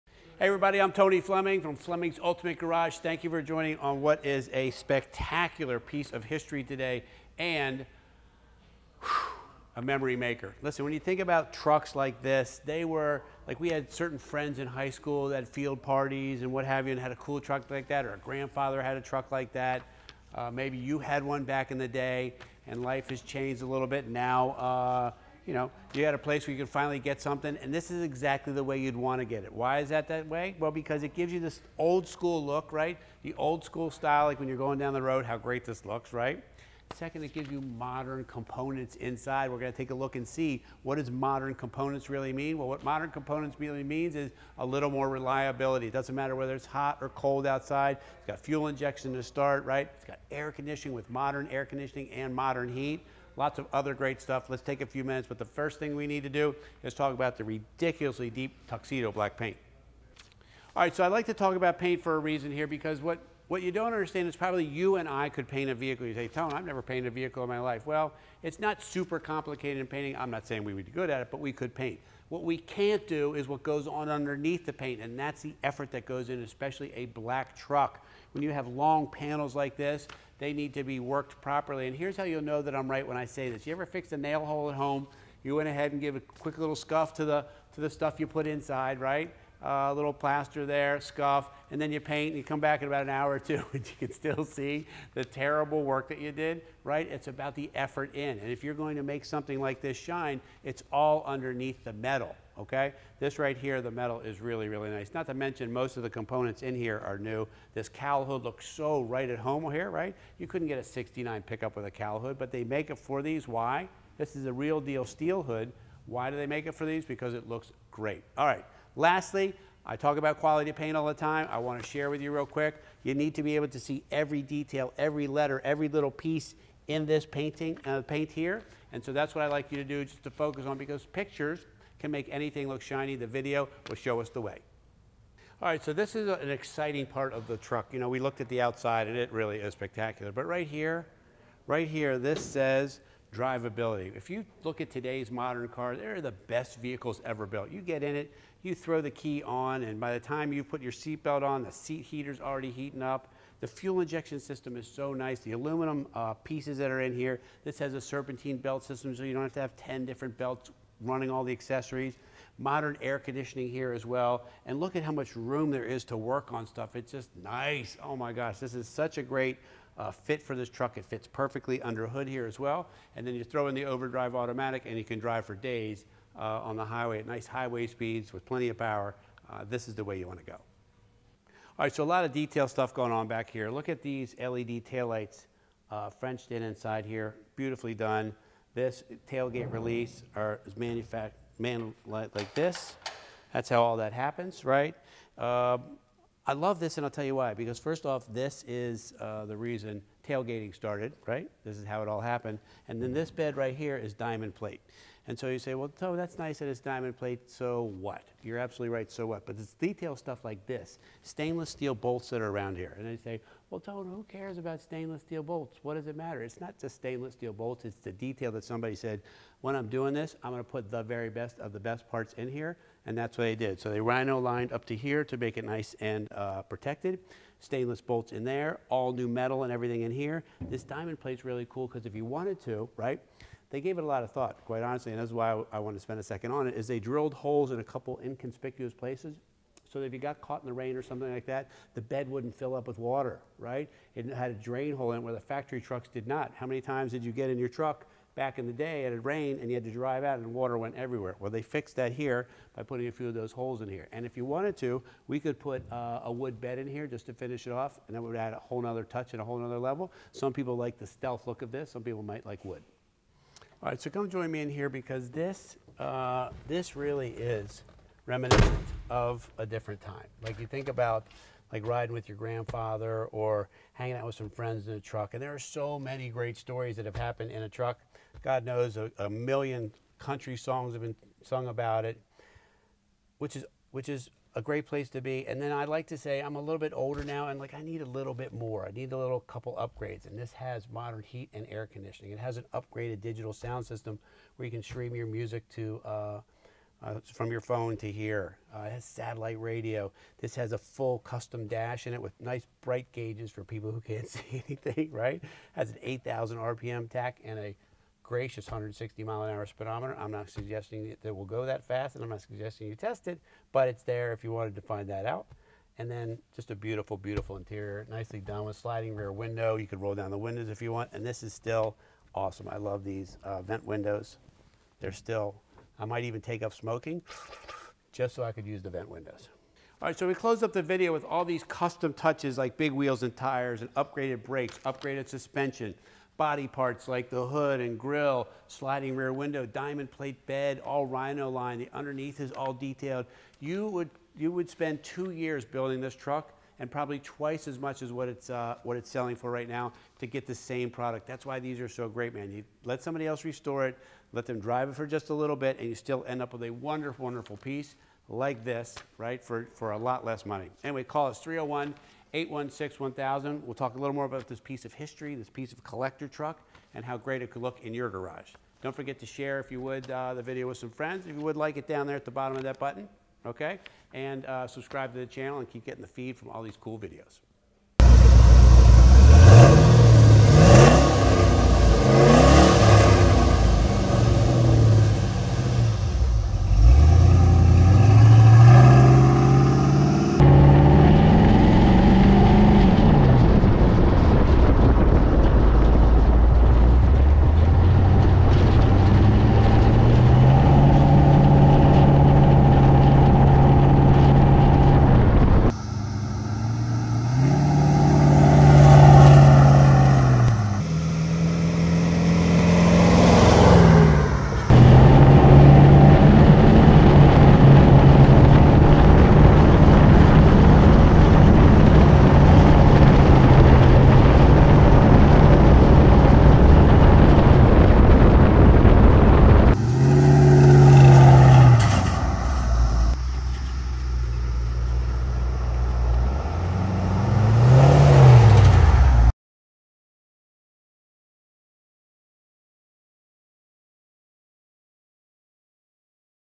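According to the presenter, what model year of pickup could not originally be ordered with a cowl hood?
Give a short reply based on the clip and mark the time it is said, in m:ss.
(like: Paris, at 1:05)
1969, at 1:50.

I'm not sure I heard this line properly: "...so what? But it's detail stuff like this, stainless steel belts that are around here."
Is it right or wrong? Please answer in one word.
wrong.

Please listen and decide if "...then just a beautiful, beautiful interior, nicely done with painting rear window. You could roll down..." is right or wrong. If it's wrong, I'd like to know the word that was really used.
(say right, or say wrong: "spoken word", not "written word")
wrong: "sliding", not "painting".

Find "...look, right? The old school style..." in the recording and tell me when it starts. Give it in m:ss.
0:32.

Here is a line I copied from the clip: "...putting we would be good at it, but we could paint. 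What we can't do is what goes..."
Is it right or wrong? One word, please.
wrong.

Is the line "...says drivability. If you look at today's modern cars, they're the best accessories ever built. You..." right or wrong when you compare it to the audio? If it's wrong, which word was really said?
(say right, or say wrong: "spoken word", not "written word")
wrong: "vehicles", not "accessories".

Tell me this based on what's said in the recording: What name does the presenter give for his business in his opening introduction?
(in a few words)
Fleming's Ultimate Garage.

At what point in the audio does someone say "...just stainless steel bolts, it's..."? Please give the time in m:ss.
3:36.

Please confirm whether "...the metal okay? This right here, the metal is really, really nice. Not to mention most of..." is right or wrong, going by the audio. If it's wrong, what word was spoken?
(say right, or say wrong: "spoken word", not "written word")
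right.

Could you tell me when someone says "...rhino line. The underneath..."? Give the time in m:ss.
5:41.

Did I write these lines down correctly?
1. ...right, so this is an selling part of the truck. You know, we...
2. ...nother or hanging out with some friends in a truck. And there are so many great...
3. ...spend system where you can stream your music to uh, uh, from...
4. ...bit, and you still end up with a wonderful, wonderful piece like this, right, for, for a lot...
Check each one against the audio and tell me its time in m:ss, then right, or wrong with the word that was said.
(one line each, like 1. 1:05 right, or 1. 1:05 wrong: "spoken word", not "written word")
1. 2:15 wrong: "exciting", not "selling"
2. 4:32 wrong: "grandfather", not "nother"
3. 4:53 wrong: "sound", not "spend"
4. 5:55 right.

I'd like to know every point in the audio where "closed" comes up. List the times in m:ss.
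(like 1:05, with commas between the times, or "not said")
5:30.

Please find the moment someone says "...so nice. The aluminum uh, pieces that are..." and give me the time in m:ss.
2:34.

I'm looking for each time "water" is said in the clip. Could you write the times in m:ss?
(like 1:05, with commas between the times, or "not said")
4:02, 4:10.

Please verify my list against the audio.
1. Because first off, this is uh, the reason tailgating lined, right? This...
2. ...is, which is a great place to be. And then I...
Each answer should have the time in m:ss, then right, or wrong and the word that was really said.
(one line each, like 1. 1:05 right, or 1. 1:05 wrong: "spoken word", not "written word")
1. 3:17 wrong: "started", not "lined"
2. 4:43 right.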